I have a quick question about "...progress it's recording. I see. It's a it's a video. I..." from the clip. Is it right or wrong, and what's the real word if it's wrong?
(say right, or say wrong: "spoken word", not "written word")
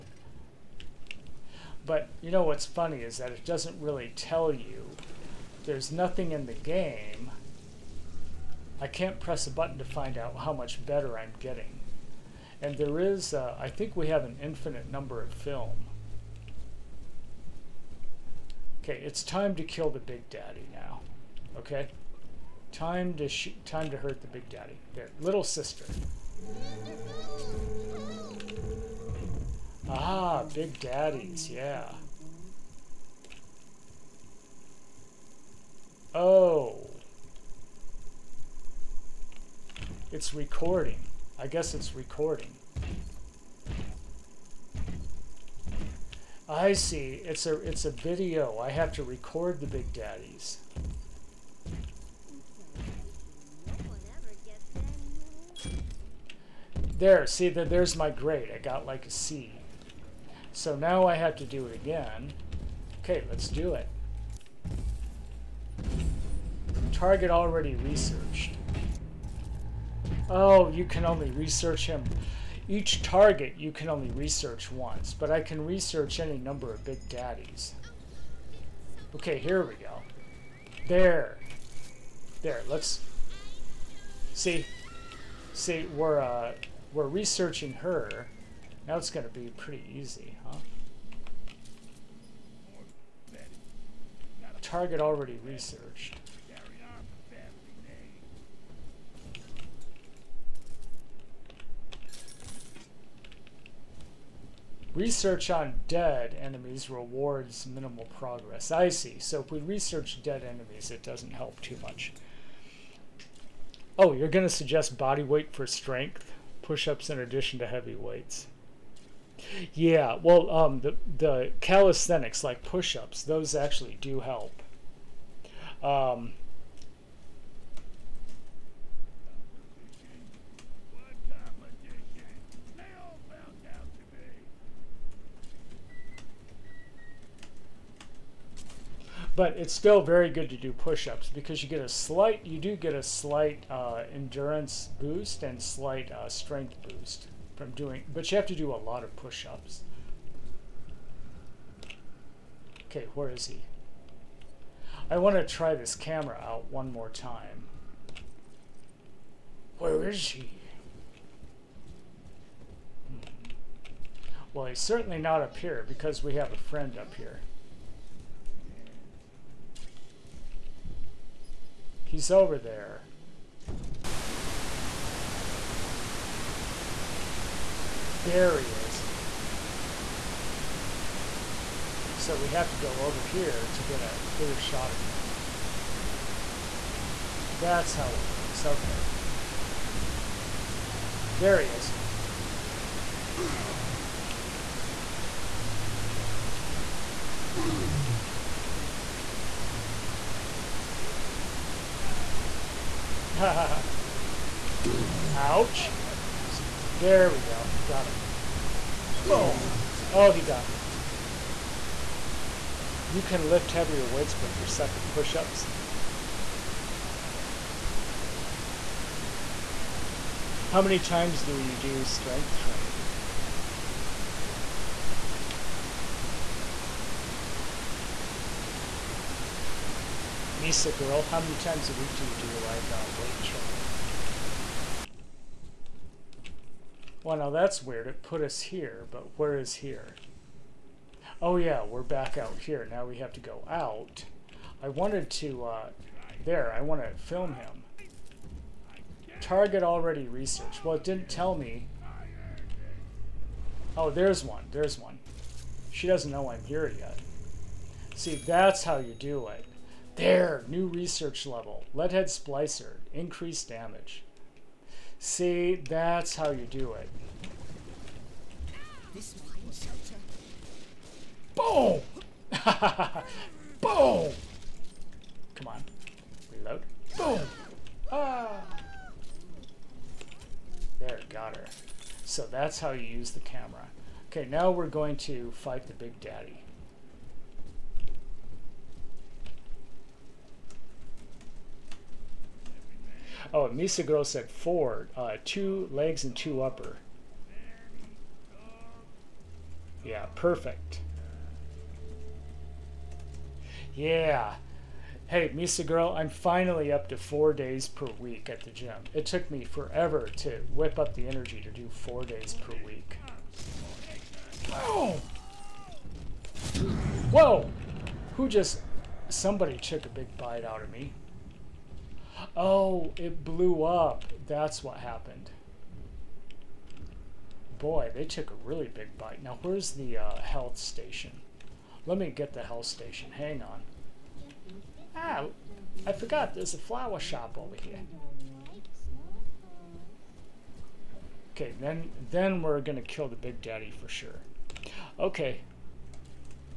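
wrong: "guess", not "progress".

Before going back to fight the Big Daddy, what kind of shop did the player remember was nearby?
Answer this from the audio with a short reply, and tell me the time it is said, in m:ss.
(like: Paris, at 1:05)
flower shop, at 5:36.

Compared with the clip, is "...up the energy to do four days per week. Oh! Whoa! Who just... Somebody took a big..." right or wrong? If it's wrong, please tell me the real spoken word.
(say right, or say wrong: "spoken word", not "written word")
right.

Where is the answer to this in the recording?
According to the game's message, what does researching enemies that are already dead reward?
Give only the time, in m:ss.
1:47.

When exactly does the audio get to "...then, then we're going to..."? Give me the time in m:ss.
5:41.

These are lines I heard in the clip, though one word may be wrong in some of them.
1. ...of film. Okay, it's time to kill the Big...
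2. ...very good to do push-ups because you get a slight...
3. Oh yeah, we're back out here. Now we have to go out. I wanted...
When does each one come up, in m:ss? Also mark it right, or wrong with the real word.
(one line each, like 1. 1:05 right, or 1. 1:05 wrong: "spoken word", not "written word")
1. 0:15 right
2. 2:20 right
3. 4:01 right.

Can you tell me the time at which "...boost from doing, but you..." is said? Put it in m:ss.
2:26.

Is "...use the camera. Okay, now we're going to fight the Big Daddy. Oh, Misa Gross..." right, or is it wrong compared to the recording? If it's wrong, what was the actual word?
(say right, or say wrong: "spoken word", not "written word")
right.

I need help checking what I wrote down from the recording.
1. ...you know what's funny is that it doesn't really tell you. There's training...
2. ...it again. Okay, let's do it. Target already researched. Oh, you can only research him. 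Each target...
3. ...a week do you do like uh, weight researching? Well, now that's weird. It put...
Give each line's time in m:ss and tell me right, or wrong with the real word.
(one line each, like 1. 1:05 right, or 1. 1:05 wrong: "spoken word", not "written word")
1. 0:02 wrong: "nothing", not "training"
2. 1:01 right
3. 3:51 wrong: "training", not "researching".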